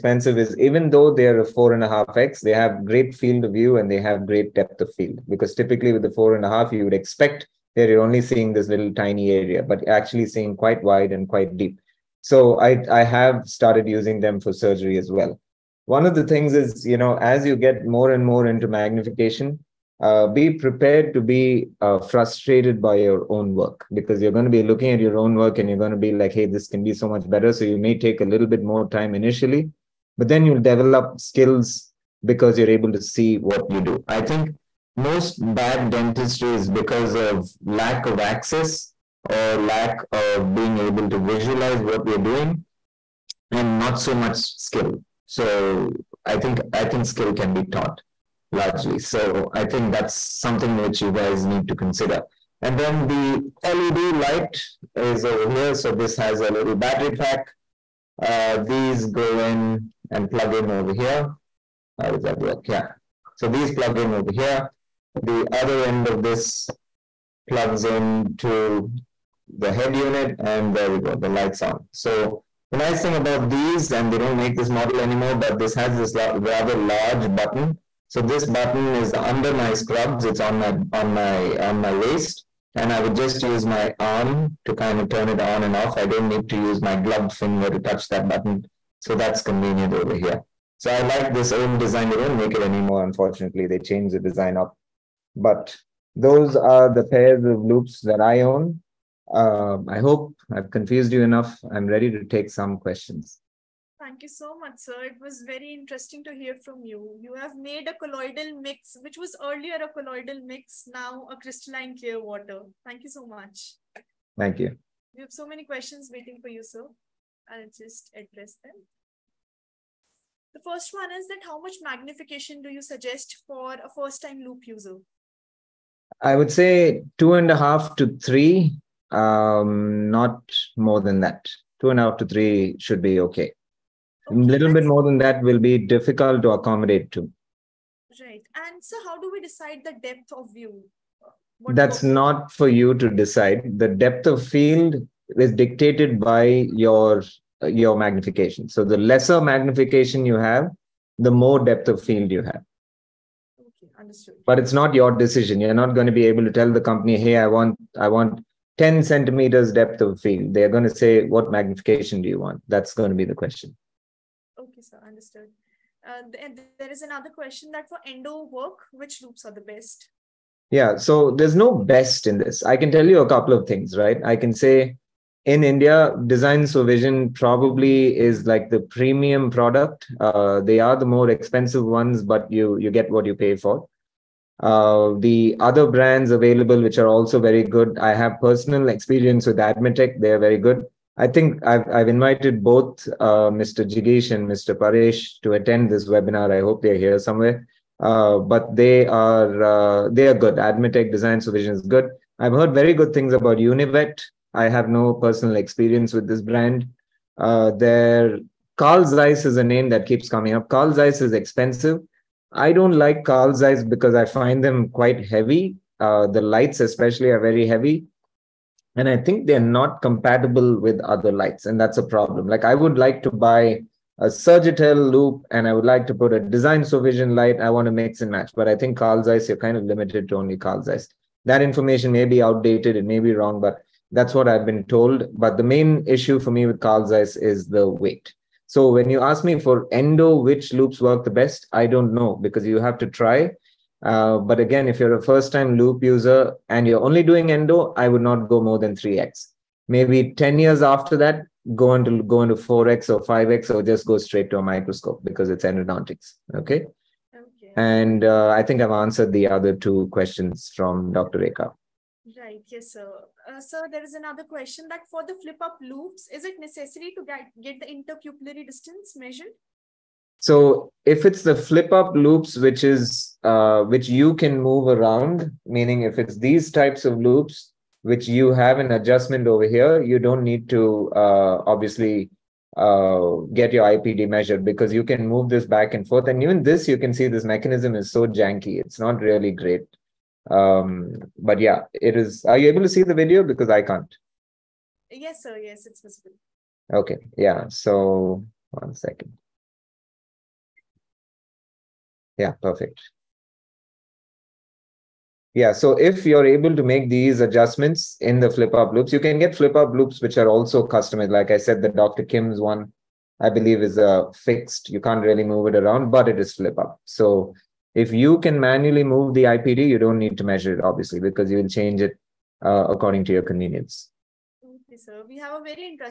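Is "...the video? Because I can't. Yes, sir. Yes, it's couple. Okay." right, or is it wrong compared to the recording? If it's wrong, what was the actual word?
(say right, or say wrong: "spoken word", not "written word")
wrong: "visible", not "couple".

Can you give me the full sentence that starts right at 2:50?
Yeah, so there's no best in this.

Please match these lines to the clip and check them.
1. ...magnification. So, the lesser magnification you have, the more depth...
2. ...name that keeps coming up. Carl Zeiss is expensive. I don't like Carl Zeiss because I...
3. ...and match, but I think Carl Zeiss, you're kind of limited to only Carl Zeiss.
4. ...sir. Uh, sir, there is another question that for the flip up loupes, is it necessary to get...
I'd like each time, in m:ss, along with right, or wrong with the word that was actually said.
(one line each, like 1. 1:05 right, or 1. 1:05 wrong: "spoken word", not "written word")
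1. 2:27 right
2. 3:29 right
3. 3:48 right
4. 4:22 right.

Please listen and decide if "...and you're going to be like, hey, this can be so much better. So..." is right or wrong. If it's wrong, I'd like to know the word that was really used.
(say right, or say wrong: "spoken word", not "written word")
right.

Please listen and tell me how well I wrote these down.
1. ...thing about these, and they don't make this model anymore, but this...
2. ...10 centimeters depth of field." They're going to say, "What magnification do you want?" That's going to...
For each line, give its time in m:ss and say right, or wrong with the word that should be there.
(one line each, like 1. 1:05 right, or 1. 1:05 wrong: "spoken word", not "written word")
1. 1:13 right
2. 2:38 right.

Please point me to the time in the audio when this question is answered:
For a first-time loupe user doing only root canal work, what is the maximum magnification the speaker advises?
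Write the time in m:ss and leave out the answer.
4:08.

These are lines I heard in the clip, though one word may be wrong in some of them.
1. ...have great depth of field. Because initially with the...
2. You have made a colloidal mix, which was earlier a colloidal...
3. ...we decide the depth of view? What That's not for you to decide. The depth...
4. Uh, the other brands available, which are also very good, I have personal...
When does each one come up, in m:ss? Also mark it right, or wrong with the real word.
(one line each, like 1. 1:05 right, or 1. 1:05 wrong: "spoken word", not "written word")
1. 0:03 wrong: "typically", not "initially"
2. 1:47 right
3. 2:19 right
4. 3:04 right.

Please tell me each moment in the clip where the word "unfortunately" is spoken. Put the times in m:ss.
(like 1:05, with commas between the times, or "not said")
1:33.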